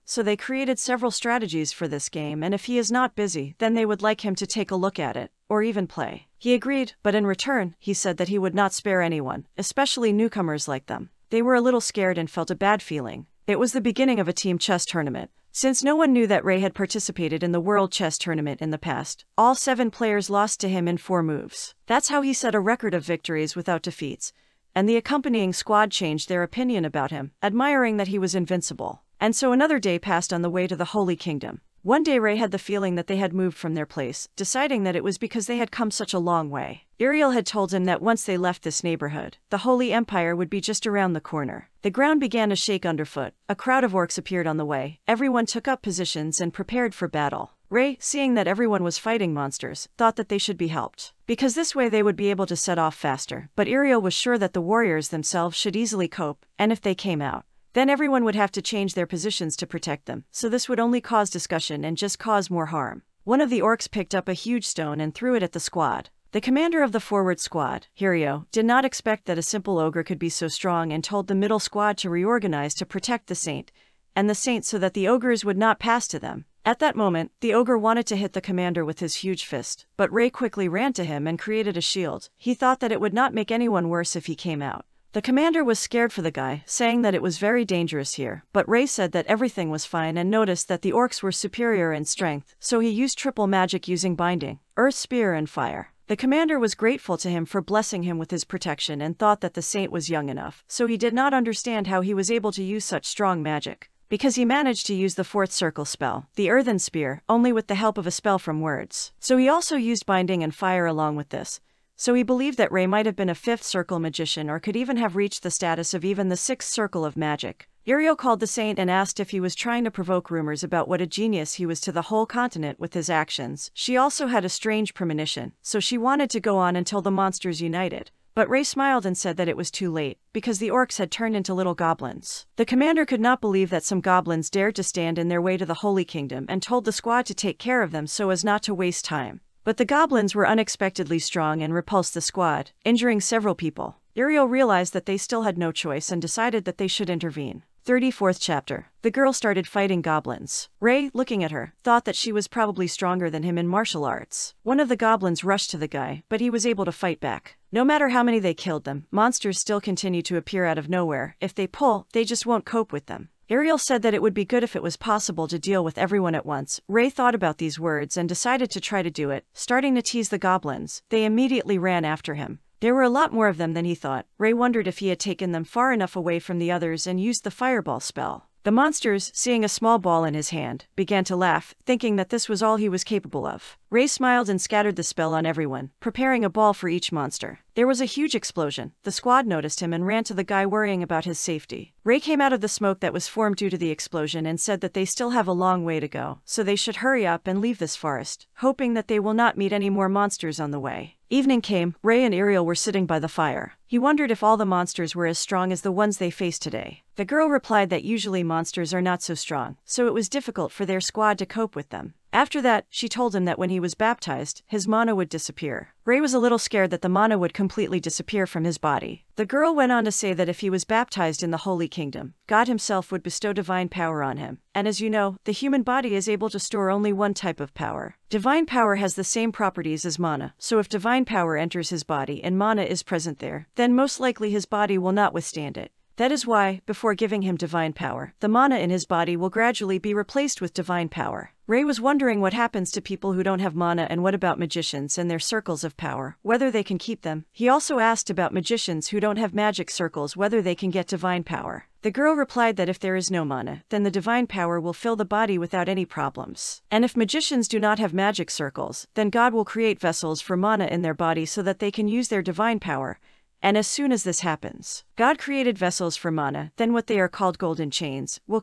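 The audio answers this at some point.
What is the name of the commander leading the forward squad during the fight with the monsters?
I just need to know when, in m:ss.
1:07.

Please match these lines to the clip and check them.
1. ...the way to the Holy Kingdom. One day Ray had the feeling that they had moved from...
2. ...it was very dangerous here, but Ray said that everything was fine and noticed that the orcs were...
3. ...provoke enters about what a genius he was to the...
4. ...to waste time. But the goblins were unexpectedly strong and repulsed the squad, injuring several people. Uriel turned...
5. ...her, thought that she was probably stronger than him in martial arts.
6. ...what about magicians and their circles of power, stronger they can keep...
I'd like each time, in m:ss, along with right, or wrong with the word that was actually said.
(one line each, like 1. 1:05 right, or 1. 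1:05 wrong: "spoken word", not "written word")
1. 0:30 right
2. 1:27 right
3. 1:59 wrong: "rumors", not "enters"
4. 2:18 wrong: "realized", not "turned"
5. 2:31 right
6. 4:04 wrong: "whether", not "stronger".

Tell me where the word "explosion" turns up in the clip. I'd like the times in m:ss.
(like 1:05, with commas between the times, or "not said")
3:08, 3:13.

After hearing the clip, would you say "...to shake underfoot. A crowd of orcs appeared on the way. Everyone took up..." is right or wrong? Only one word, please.
right.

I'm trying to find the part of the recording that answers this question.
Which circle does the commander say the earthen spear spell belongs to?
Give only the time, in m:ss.
1:45.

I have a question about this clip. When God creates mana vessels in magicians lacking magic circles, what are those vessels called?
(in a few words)
golden chains.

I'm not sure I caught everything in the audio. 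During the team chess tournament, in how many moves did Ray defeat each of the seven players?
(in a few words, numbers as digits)
4.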